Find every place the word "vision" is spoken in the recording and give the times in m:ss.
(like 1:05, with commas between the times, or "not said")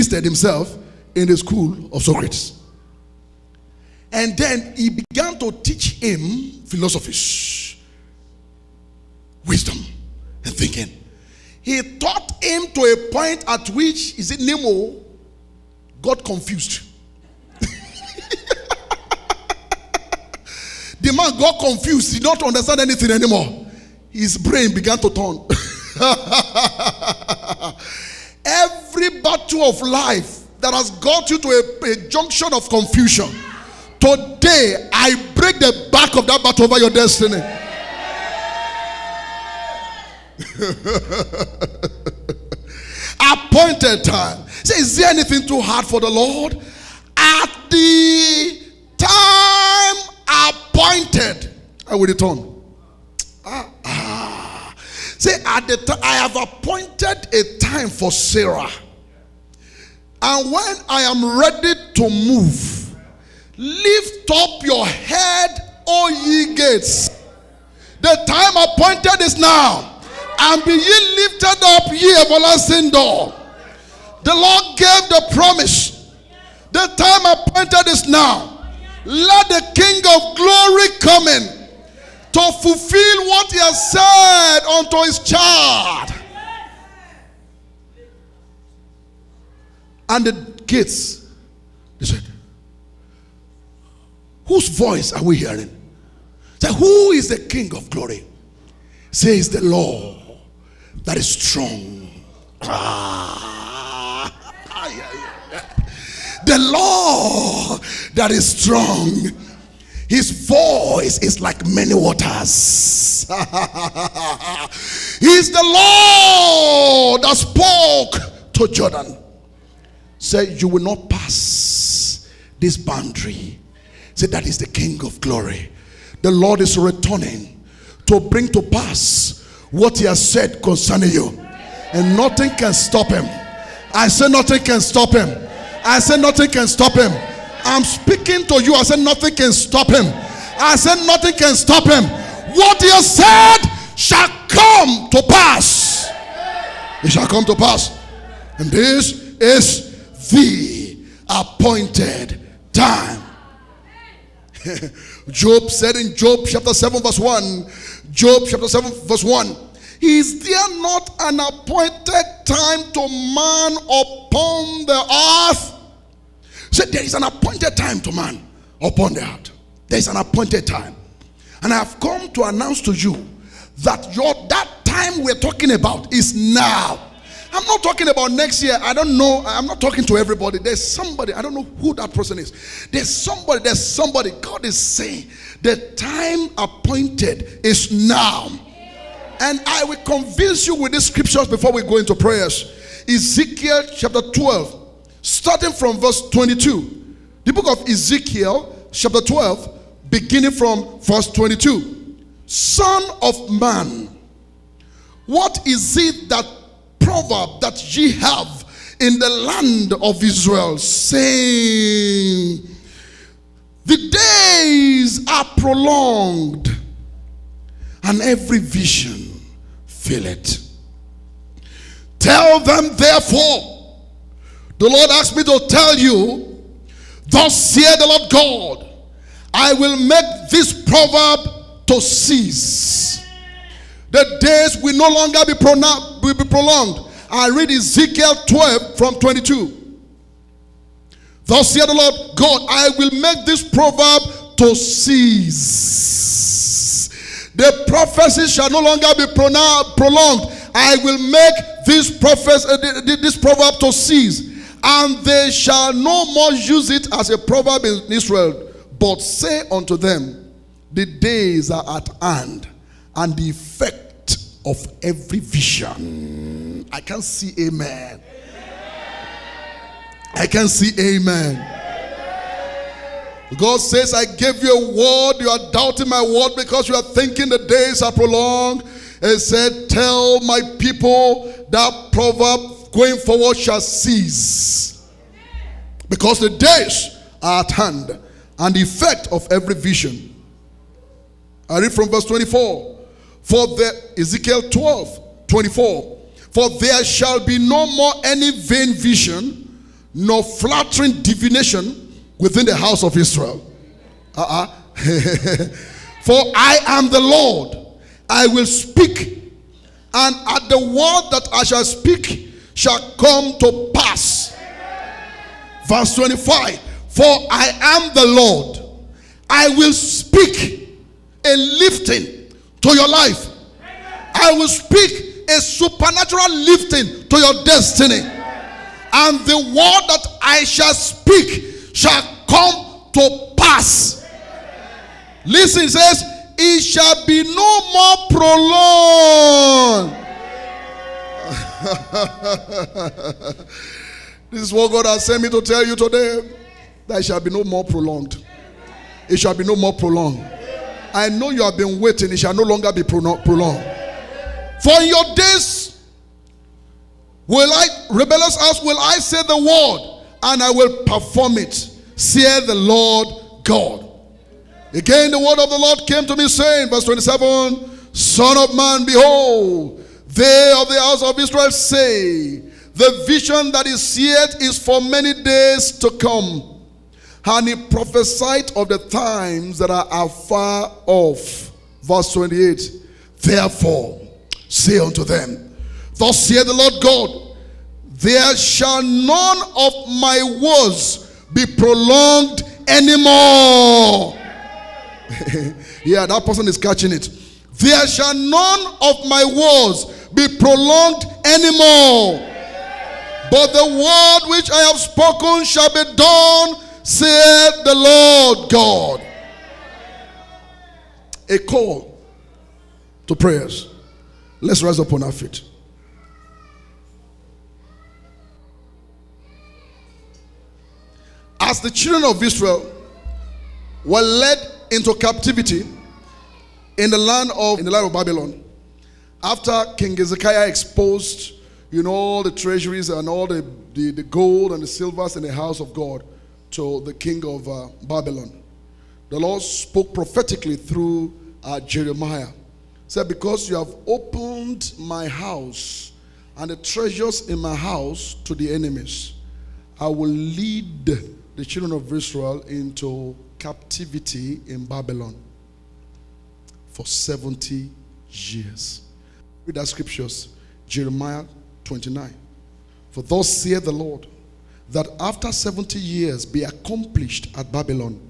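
3:38, 4:25, 4:49, 4:58, 6:13.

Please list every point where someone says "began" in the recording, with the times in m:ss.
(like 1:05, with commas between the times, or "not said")
0:04, 0:24.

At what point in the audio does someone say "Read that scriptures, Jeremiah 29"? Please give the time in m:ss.
7:39.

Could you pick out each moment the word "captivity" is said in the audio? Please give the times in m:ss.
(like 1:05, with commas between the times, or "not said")
7:05, 7:33.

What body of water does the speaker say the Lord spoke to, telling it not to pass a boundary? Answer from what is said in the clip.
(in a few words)
Jordan.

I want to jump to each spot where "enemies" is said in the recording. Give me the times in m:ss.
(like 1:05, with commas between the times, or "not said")
7:28.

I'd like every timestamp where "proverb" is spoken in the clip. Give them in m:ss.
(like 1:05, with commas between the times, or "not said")
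3:26, 3:50, 4:03, 4:13, 4:17, 4:42.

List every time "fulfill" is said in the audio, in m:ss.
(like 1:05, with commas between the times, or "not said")
1:22.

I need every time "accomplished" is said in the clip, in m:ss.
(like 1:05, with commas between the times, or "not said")
7:46.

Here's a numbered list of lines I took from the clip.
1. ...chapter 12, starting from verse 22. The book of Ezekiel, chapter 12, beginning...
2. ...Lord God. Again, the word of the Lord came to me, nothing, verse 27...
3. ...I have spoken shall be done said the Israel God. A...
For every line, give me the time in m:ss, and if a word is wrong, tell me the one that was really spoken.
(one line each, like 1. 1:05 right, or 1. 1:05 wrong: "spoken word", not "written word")
1. 3:13 right
2. 6:02 wrong: "saying", not "nothing"
3. 6:44 wrong: "Lord", not "Israel".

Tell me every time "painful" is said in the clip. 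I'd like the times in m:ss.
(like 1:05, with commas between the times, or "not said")
not said.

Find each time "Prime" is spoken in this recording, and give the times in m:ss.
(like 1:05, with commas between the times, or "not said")
not said.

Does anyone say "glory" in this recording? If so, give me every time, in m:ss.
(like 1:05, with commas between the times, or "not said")
1:20, 1:37, 2:05.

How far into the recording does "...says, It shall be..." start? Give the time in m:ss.
5:35.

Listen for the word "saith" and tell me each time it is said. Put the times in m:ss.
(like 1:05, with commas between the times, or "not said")
3:47, 6:26, 7:43.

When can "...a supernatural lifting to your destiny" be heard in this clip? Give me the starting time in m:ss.
5:25.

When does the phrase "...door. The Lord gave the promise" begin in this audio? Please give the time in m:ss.
1:12.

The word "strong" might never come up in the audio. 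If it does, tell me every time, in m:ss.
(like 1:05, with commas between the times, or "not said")
1:41, 1:48.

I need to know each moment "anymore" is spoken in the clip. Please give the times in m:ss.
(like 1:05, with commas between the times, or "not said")
0:23, 6:32, 6:41.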